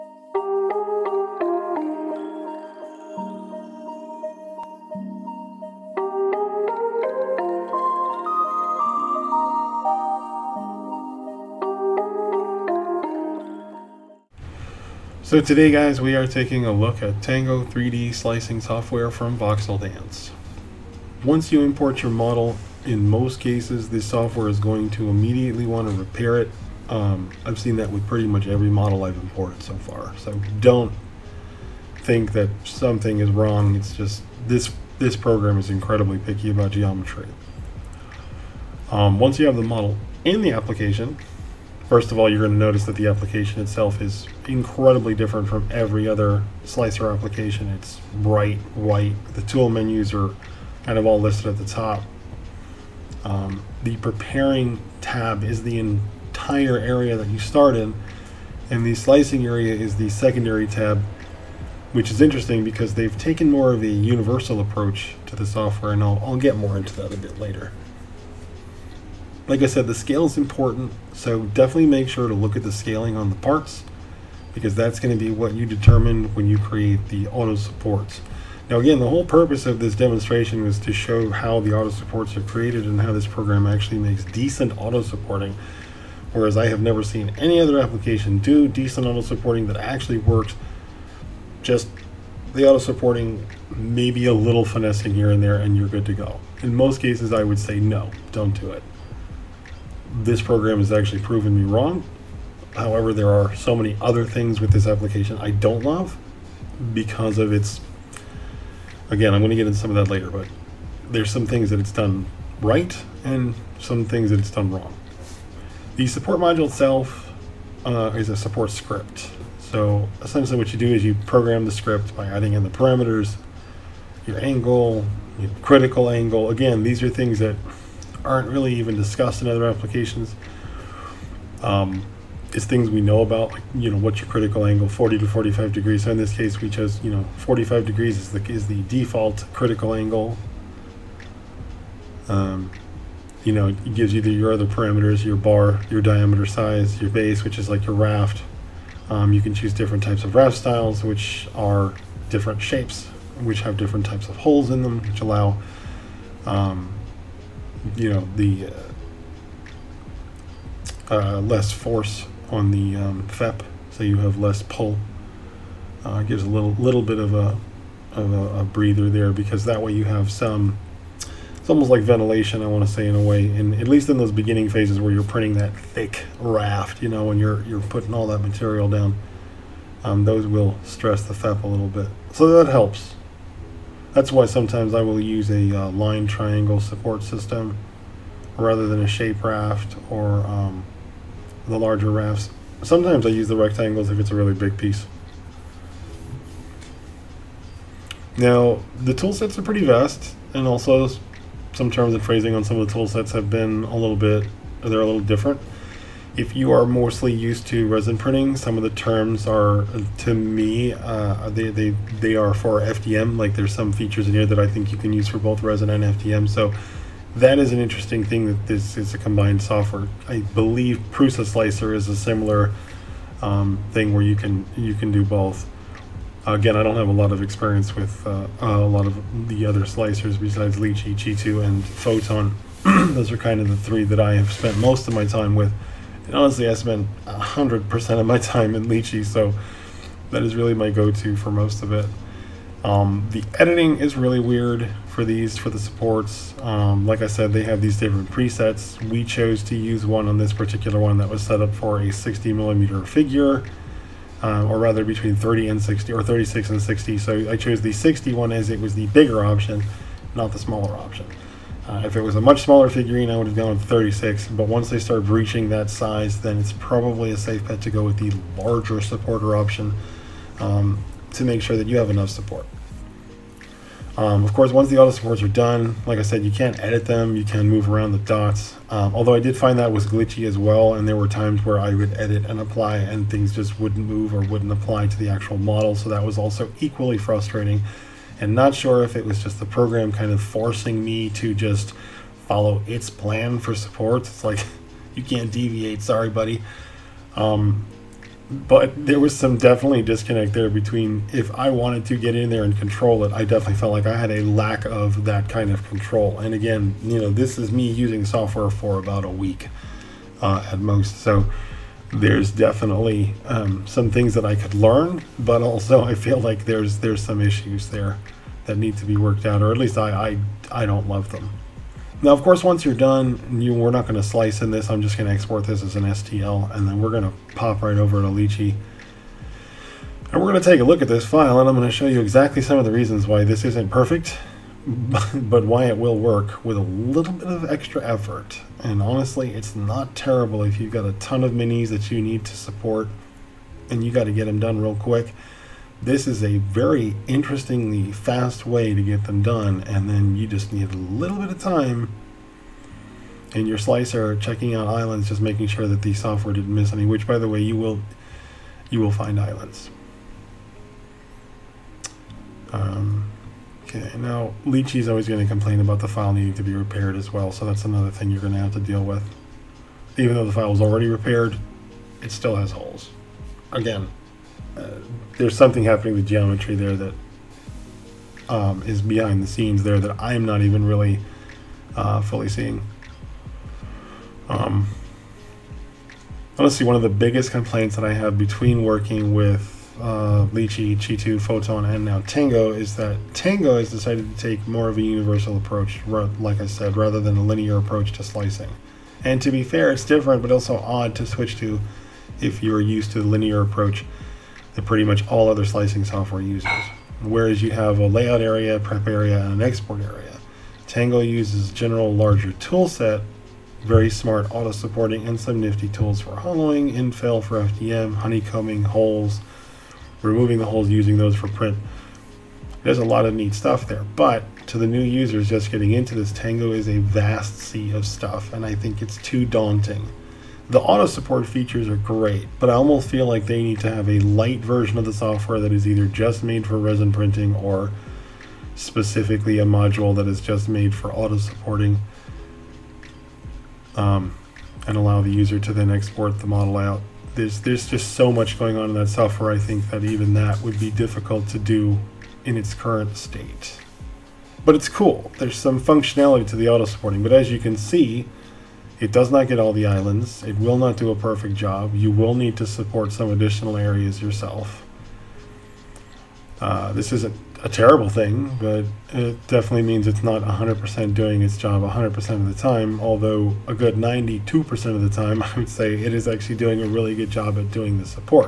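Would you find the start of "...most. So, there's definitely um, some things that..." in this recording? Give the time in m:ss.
5:10.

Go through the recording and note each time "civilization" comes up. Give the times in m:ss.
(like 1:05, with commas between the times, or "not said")
not said.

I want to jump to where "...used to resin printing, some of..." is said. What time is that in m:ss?
3:27.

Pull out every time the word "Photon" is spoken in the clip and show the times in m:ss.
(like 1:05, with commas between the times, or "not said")
3:51, 6:31.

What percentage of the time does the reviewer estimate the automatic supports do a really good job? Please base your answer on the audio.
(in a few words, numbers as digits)
92%.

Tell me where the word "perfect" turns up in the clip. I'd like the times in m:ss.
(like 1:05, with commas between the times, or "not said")
5:33, 7:41.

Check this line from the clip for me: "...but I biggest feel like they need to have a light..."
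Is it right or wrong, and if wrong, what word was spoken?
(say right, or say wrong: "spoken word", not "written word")
wrong: "almost", not "biggest".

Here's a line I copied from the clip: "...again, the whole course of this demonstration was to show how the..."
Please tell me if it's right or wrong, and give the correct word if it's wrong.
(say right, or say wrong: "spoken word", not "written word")
wrong: "purpose", not "course".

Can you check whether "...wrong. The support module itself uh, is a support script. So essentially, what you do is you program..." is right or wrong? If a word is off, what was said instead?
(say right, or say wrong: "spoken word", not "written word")
right.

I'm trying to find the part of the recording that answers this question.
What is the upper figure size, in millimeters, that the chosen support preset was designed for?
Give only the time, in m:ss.
4:12.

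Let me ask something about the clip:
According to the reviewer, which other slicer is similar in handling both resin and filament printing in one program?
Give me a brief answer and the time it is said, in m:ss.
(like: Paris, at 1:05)
Prusa Slicer, at 3:41.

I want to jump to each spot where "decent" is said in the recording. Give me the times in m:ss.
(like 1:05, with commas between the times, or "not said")
1:24, 1:28.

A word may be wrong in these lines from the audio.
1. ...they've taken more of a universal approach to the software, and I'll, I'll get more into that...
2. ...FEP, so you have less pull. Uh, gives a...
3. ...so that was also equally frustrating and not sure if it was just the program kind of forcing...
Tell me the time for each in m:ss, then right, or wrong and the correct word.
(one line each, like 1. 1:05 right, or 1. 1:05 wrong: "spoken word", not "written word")
1. 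1:02 right
2. 2:43 right
3. 4:45 right.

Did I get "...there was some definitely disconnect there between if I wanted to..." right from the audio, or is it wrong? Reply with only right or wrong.
right.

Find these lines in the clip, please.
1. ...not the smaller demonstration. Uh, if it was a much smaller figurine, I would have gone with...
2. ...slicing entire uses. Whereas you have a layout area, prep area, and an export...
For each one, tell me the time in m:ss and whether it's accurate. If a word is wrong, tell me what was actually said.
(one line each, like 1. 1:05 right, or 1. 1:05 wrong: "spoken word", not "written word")
1. 4:20 wrong: "option", not "demonstration"
2. 6:45 wrong: "software", not "entire".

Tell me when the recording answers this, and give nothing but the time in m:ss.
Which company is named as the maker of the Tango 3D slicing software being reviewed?
0:19.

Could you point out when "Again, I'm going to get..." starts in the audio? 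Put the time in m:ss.
1:49.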